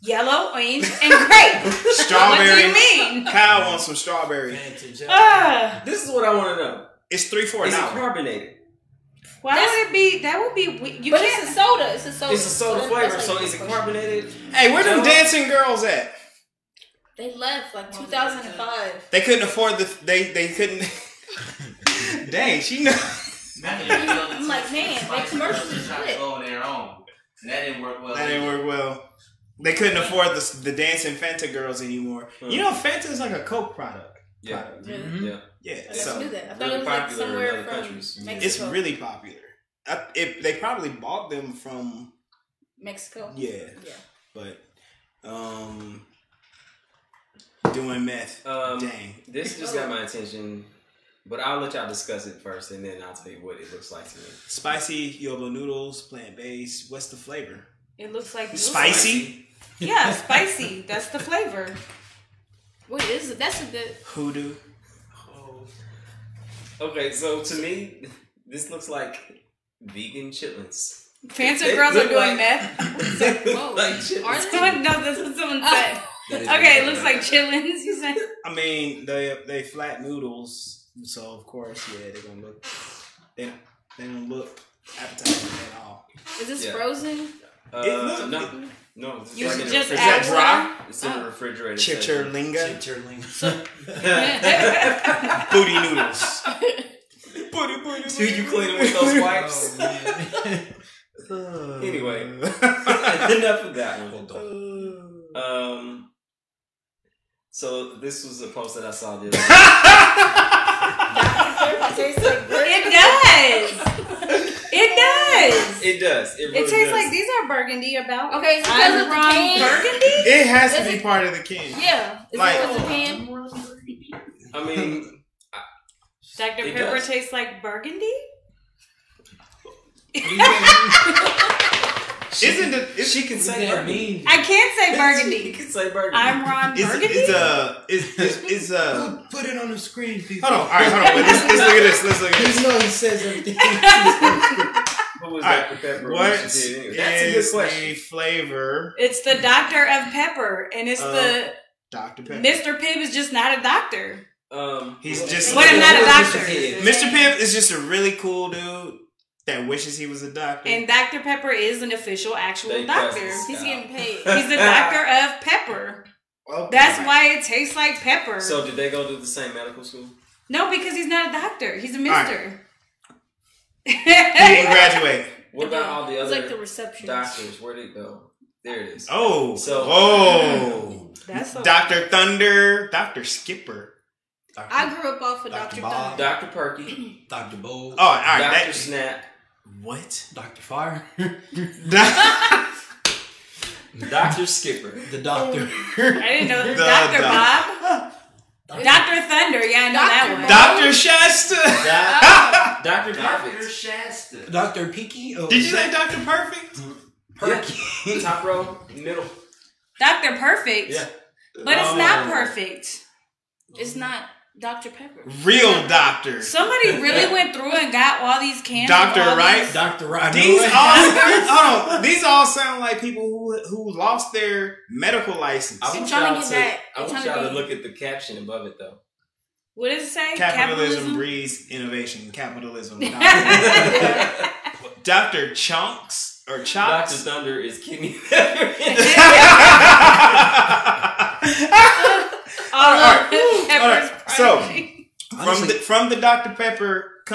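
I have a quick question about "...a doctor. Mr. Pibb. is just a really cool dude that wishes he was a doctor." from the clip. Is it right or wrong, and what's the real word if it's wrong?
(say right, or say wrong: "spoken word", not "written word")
right.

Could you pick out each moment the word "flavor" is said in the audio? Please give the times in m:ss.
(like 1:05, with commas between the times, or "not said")
0:12, 0:57, 1:01, 2:27.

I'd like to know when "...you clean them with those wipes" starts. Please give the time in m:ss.
1:38.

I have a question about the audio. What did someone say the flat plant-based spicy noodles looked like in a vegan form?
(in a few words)
vegan chitlins.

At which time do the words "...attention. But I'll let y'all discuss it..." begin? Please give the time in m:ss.
0:50.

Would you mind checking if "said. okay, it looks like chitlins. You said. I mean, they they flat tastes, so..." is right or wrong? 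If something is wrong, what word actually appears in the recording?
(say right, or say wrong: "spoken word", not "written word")
wrong: "noodles", not "tastes".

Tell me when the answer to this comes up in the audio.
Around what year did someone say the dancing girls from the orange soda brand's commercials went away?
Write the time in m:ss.
0:17.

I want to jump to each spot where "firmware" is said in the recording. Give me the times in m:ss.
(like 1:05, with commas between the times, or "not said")
not said.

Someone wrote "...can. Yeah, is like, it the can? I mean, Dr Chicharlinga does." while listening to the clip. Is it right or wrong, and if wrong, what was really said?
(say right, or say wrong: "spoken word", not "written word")
wrong: "Pepper", not "Chicharlinga".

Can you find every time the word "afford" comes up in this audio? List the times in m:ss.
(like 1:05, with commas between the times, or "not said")
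0:19, 0:29.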